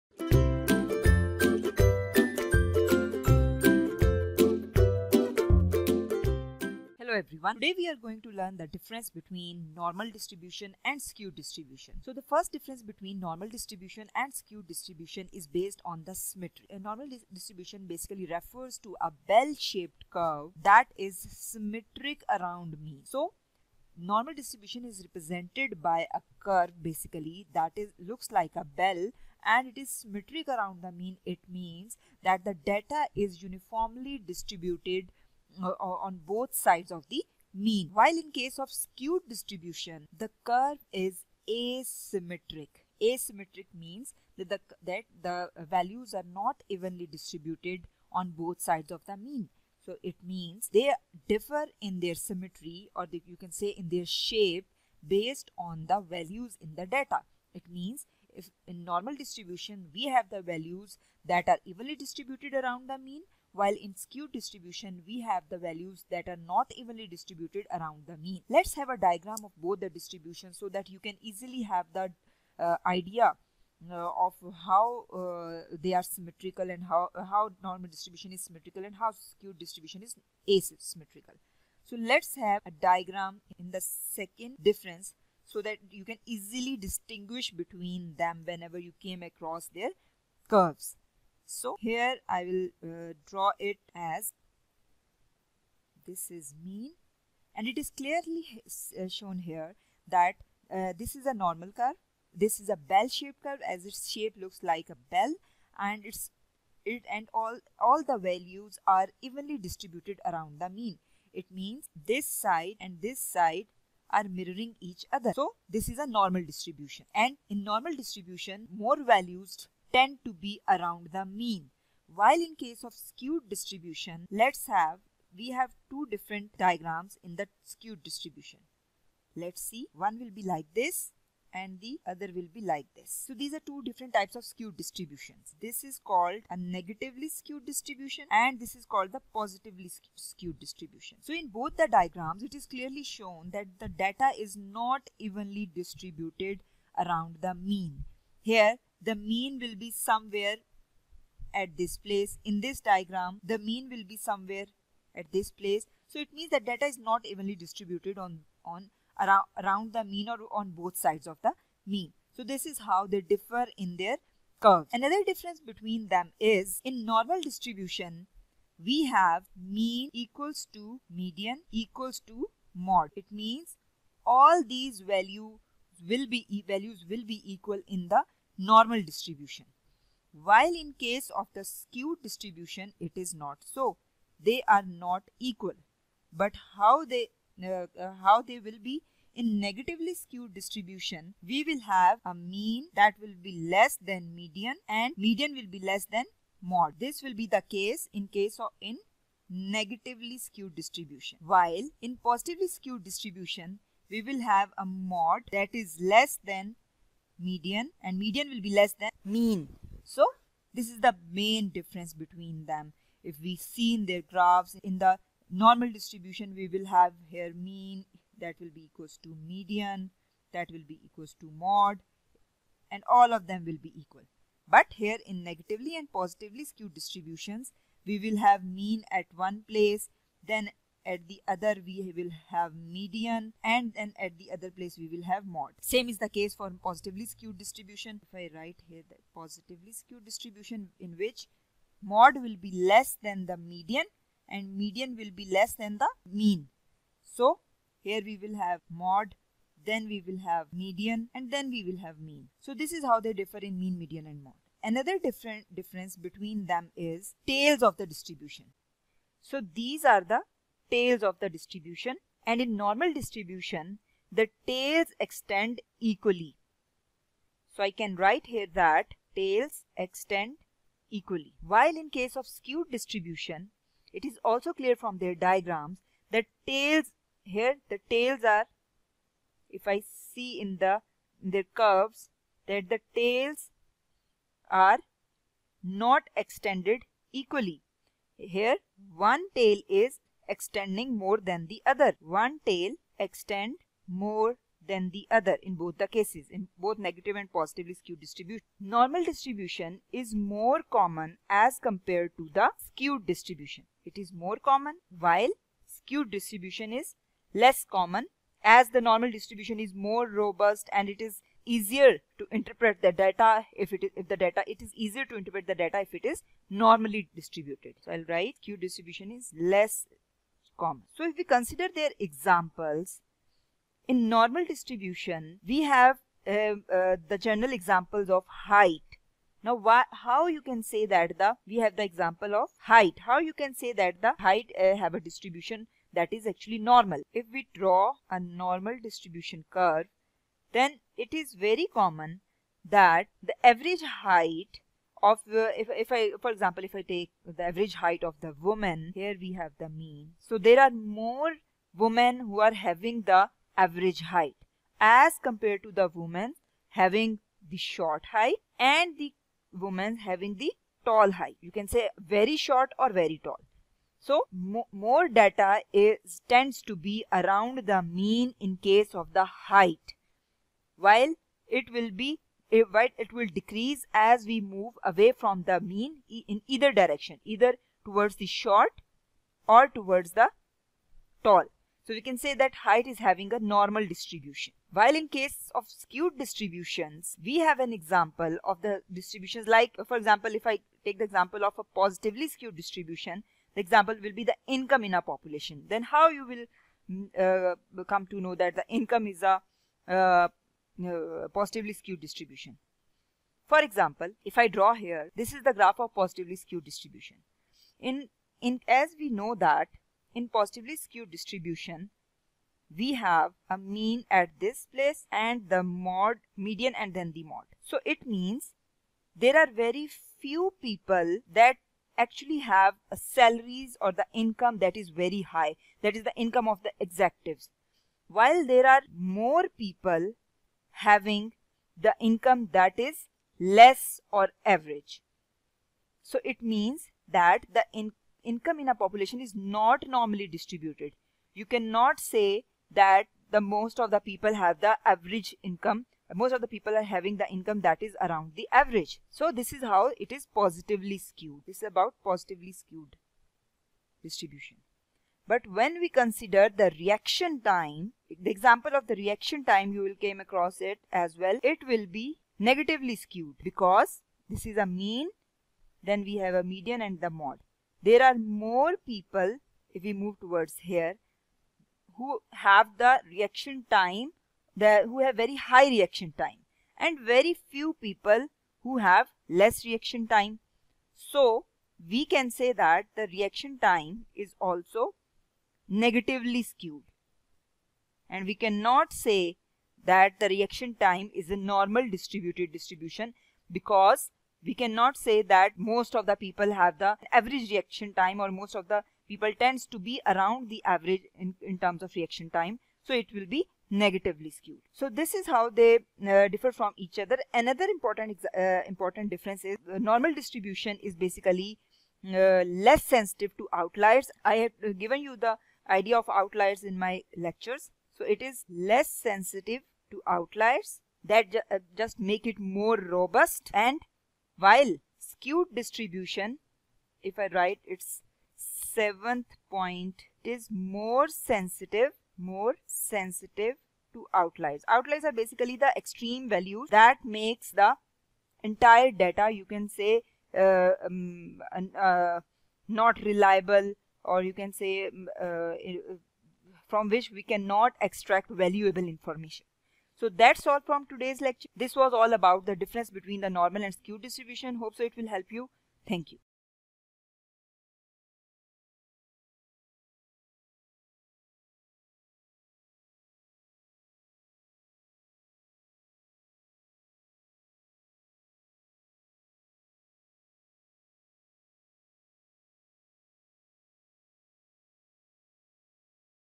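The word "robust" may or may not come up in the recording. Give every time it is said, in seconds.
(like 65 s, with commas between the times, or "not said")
310 s, 522 s.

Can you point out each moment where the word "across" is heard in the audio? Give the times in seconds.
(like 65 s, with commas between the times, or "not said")
89 s, 460 s.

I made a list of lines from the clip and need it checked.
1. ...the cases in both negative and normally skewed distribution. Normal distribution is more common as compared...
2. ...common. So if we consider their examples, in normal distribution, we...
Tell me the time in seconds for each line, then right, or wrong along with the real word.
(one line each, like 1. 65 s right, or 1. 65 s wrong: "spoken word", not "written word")
1. 295 s wrong: "positively", not "normally"
2. 320 s right.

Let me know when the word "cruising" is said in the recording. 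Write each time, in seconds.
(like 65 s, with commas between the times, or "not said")
not said.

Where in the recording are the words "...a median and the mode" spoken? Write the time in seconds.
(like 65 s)
466 s.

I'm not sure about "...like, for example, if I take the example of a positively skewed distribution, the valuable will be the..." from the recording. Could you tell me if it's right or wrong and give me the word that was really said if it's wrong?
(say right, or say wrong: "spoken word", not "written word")
wrong: "example", not "valuable".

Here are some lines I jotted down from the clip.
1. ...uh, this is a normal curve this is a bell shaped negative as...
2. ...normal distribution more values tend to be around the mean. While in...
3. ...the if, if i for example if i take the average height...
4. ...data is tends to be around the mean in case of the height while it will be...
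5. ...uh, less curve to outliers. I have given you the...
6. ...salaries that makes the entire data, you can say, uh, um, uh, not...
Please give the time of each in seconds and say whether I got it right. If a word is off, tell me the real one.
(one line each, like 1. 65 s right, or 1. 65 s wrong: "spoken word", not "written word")
1. 100 s wrong: "curve", not "negative"
2. 117 s right
3. 345 s right
4. 365 s right
5. 512 s wrong: "sensitive", not "curve"
6. 536 s wrong: "values", not "salaries".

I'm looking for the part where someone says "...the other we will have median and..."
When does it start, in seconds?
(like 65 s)
231 s.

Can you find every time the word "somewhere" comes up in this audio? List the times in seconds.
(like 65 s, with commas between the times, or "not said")
149 s, 154 s.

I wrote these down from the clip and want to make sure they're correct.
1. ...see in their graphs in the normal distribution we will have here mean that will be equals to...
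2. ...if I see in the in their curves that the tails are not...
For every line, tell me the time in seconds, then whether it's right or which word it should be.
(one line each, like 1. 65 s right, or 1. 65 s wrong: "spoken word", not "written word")
1. 213 s right
2. 279 s right.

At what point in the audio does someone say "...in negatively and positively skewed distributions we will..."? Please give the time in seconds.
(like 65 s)
225 s.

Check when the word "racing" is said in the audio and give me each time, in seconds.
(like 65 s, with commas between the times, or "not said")
not said.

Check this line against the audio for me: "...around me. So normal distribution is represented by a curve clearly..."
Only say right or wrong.
wrong.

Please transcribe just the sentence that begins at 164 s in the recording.
Another difference between them is in normal distribution, we have mean equals to median equals to mode.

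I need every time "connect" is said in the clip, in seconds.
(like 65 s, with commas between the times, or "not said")
not said.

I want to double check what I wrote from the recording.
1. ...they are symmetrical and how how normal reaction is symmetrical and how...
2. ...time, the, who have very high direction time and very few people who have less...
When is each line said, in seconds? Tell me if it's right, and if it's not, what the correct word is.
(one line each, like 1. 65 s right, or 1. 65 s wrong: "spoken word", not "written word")
1. 75 s wrong: "distribution", not "reaction"
2. 473 s wrong: "reaction", not "direction".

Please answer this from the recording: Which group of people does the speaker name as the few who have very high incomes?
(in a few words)
Executives.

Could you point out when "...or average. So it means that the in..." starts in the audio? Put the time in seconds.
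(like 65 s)
434 s.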